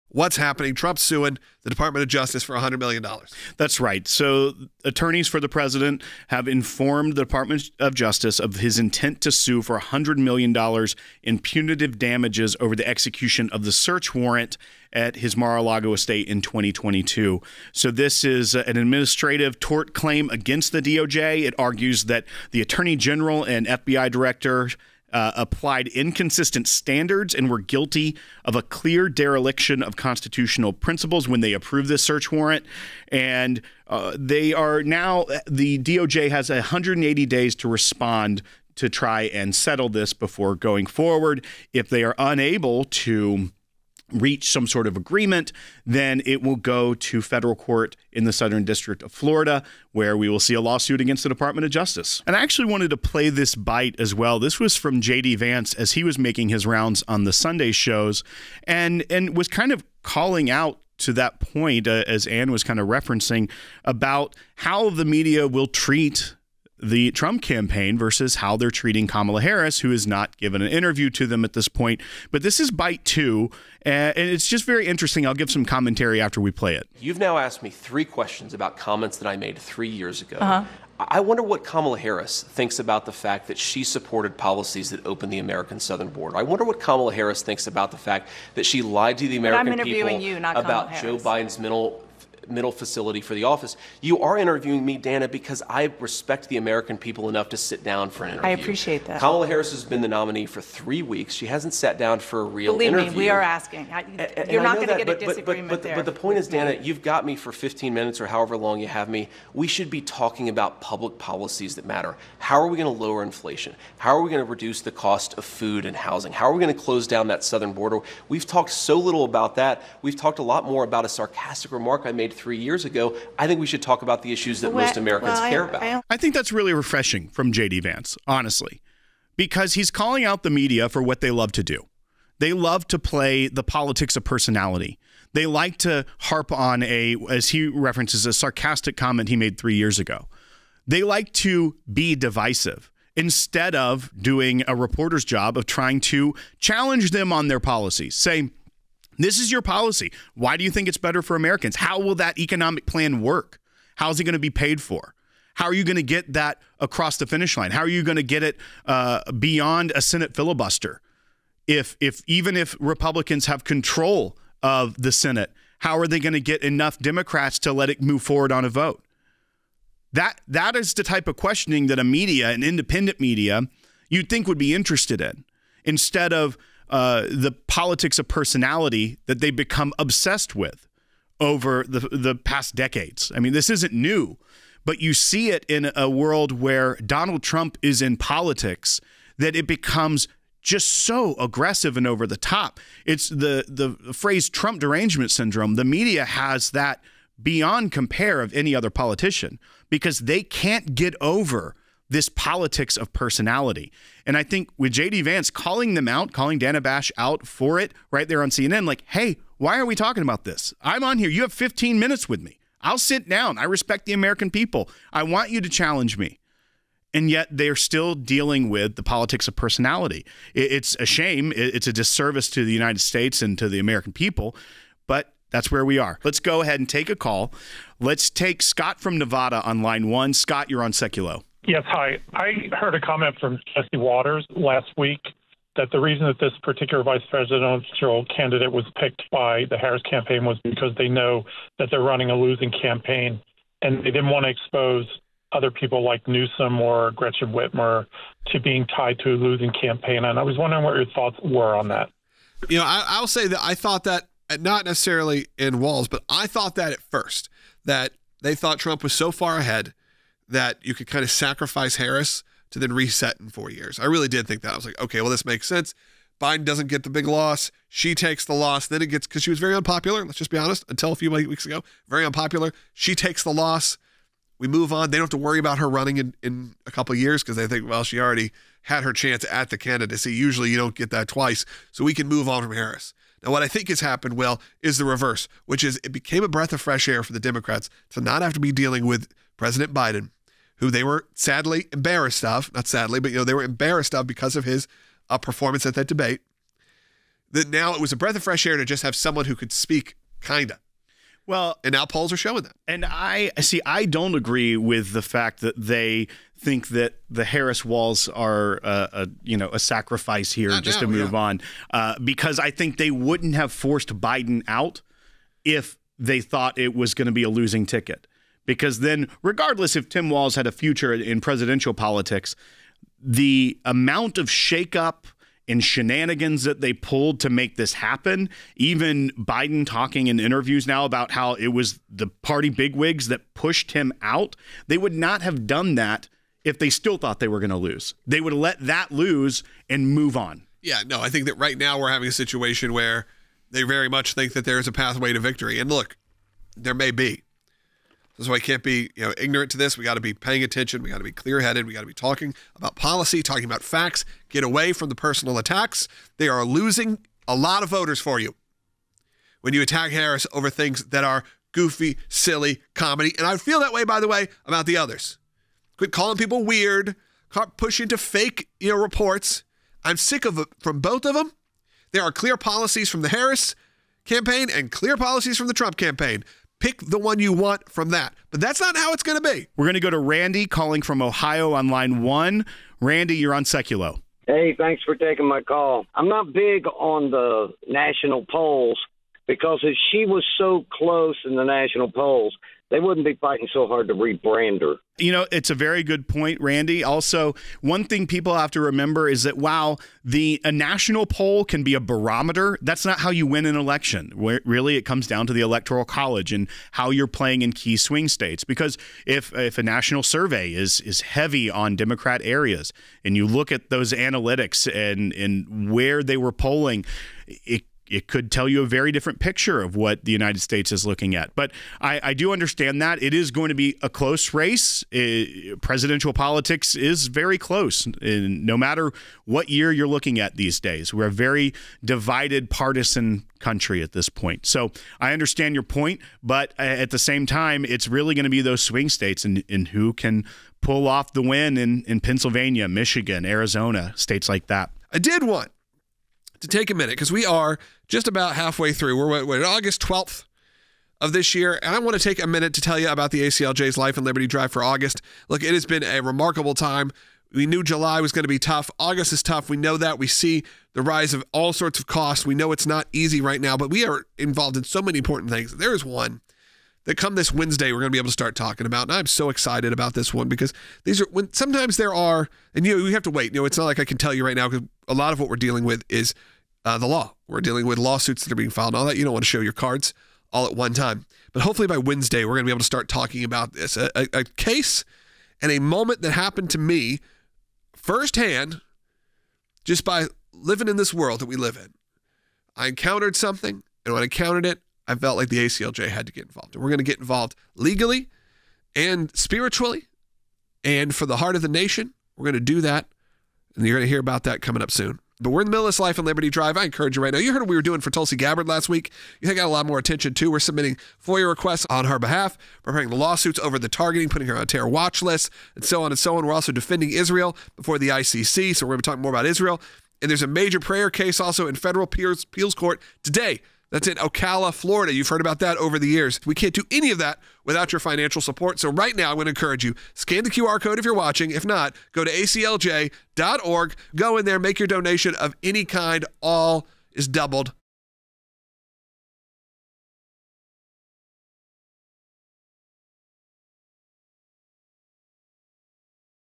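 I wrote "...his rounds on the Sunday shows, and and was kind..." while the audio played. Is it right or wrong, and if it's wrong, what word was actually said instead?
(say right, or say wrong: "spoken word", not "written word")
right.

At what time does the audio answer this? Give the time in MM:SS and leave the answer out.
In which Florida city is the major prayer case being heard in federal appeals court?
08:44.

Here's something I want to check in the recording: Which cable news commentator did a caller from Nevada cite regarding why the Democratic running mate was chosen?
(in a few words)
Jesse Watters.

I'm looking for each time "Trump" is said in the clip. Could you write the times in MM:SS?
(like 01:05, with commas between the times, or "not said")
00:00, 01:07, 03:07, 03:14, 04:18, 06:15.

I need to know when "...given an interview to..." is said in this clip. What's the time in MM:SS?
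01:10.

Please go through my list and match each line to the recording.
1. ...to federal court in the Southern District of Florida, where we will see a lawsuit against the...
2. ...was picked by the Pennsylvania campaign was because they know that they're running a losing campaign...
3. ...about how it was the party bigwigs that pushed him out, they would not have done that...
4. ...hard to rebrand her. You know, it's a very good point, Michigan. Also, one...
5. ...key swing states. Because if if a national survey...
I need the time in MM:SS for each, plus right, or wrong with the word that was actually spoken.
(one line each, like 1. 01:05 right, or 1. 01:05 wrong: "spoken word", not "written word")
1. 00:46 right
2. 03:58 wrong: "Harris", not "Pennsylvania"
3. 05:31 right
4. 06:33 wrong: "Randy", not "Michigan"
5. 06:47 right.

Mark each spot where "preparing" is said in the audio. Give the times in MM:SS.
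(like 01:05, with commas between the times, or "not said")
08:32.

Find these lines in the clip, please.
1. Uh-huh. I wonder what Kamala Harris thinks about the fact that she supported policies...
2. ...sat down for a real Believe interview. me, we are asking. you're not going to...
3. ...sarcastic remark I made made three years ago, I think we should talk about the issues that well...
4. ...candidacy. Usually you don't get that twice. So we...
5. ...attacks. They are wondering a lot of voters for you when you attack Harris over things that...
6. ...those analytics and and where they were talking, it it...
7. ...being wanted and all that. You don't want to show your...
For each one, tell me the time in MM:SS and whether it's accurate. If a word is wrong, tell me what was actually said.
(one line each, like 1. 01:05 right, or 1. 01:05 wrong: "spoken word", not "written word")
1. 01:20 right
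2. 01:41 right
3. 02:01 right
4. 04:39 right
5. 05:55 wrong: "losing", not "wondering"
6. 06:53 wrong: "polling", not "talking"
7. 07:58 wrong: "filed", not "wanted".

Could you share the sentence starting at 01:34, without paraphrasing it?
You are interviewing me, Dana, because I respect the American people enough to sit down for an interview.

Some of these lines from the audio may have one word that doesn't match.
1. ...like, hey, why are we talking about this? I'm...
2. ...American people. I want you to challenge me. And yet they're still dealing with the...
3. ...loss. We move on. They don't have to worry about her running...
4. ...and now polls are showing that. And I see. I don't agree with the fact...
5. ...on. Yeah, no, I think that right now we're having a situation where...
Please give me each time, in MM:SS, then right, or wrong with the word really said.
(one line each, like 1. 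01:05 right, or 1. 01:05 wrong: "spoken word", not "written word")
1. 03:28 right
2. 03:34 right
3. 04:33 right
4. 05:01 right
5. 05:40 right.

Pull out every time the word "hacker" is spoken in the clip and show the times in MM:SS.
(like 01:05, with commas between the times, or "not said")
not said.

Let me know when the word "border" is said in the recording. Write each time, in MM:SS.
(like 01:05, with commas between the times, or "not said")
01:26, 01:57.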